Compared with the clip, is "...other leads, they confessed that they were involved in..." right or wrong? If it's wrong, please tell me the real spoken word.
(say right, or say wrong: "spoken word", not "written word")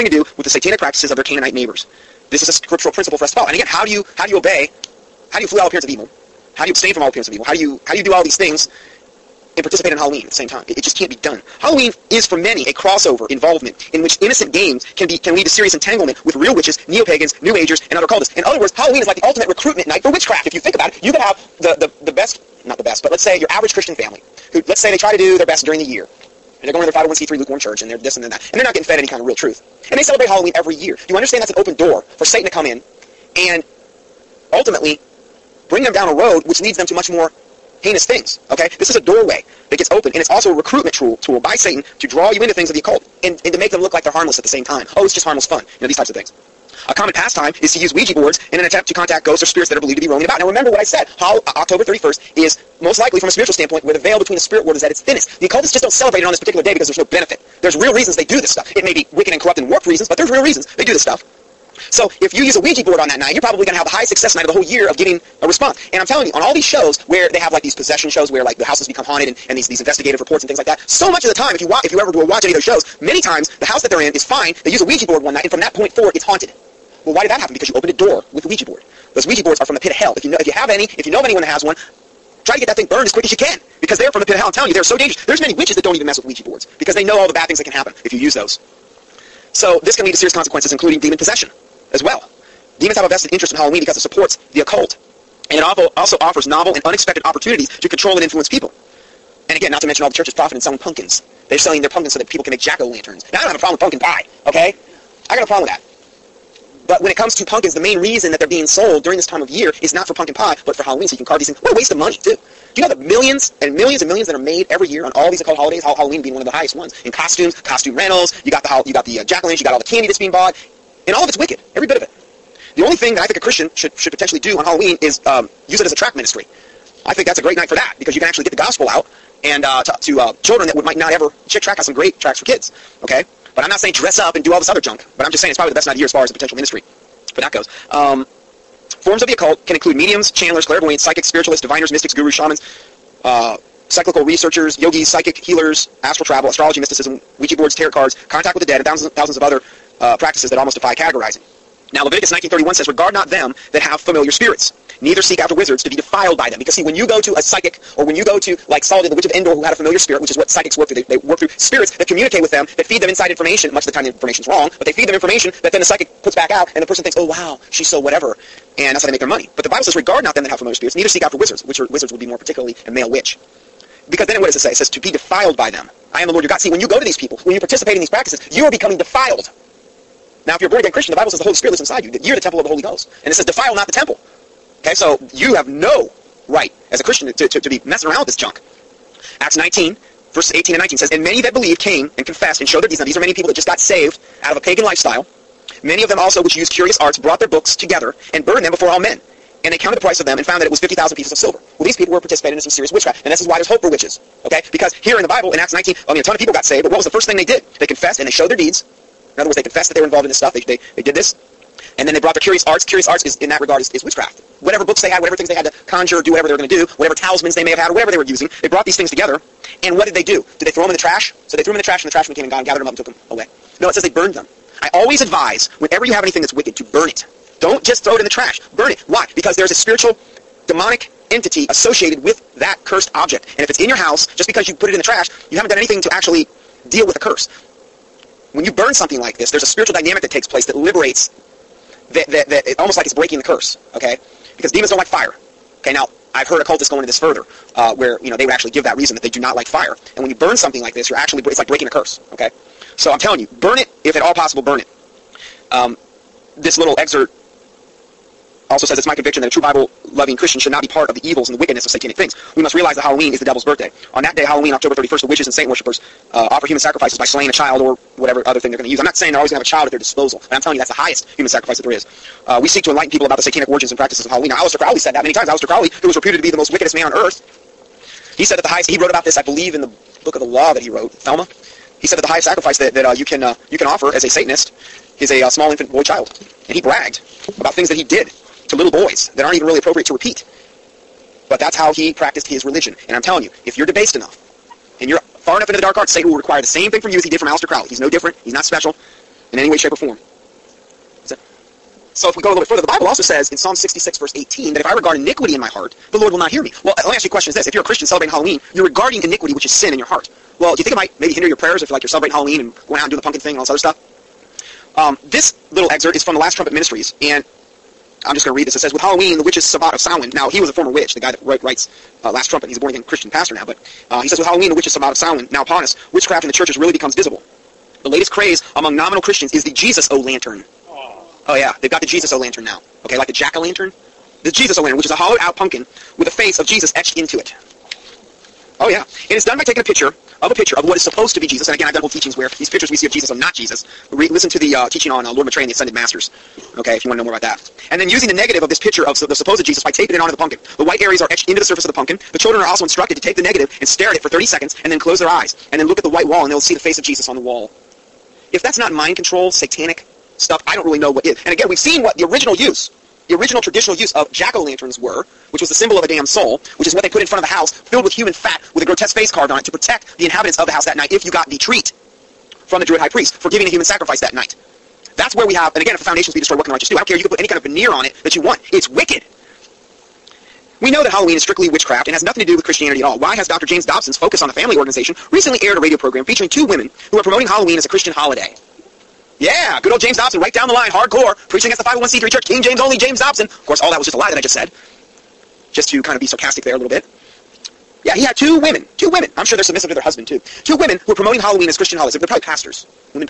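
wrong: "words", not "leads".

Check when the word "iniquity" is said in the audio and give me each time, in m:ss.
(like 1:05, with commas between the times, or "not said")
5:05, 5:09.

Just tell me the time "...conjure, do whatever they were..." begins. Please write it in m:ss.
3:35.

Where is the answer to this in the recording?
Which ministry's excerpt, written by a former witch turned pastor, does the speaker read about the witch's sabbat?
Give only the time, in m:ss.
5:16.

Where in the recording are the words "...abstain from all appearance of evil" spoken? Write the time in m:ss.
0:06.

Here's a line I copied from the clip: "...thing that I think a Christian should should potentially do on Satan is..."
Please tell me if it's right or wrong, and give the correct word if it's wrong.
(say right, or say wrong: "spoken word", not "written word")
wrong: "Halloween", not "Satan".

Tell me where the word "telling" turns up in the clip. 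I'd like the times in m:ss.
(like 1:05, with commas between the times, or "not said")
1:06, 1:24, 4:13, 4:30, 4:53.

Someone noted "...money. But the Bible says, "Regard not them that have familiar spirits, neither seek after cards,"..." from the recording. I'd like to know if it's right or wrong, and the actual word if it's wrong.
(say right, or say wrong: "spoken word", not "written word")
wrong: "wizards", not "cards".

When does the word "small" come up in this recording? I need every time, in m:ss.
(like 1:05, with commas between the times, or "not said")
4:45.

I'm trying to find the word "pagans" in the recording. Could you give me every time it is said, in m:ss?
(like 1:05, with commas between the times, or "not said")
0:16, 3:14.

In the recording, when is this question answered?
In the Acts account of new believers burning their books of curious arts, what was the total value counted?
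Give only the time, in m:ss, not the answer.
3:20.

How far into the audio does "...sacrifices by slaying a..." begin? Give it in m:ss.
4:26.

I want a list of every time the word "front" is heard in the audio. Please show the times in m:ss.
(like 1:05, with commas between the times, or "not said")
6:07.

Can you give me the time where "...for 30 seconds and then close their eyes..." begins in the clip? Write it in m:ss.
5:54.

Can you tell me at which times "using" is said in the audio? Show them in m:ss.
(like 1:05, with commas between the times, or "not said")
3:38, 5:48.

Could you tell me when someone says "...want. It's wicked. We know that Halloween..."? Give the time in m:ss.
6:18.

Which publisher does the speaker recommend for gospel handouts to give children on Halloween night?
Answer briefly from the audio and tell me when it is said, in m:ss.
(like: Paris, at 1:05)
Chick Tract, at 2:11.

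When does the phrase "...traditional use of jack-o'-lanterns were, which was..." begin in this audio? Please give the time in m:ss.
6:03.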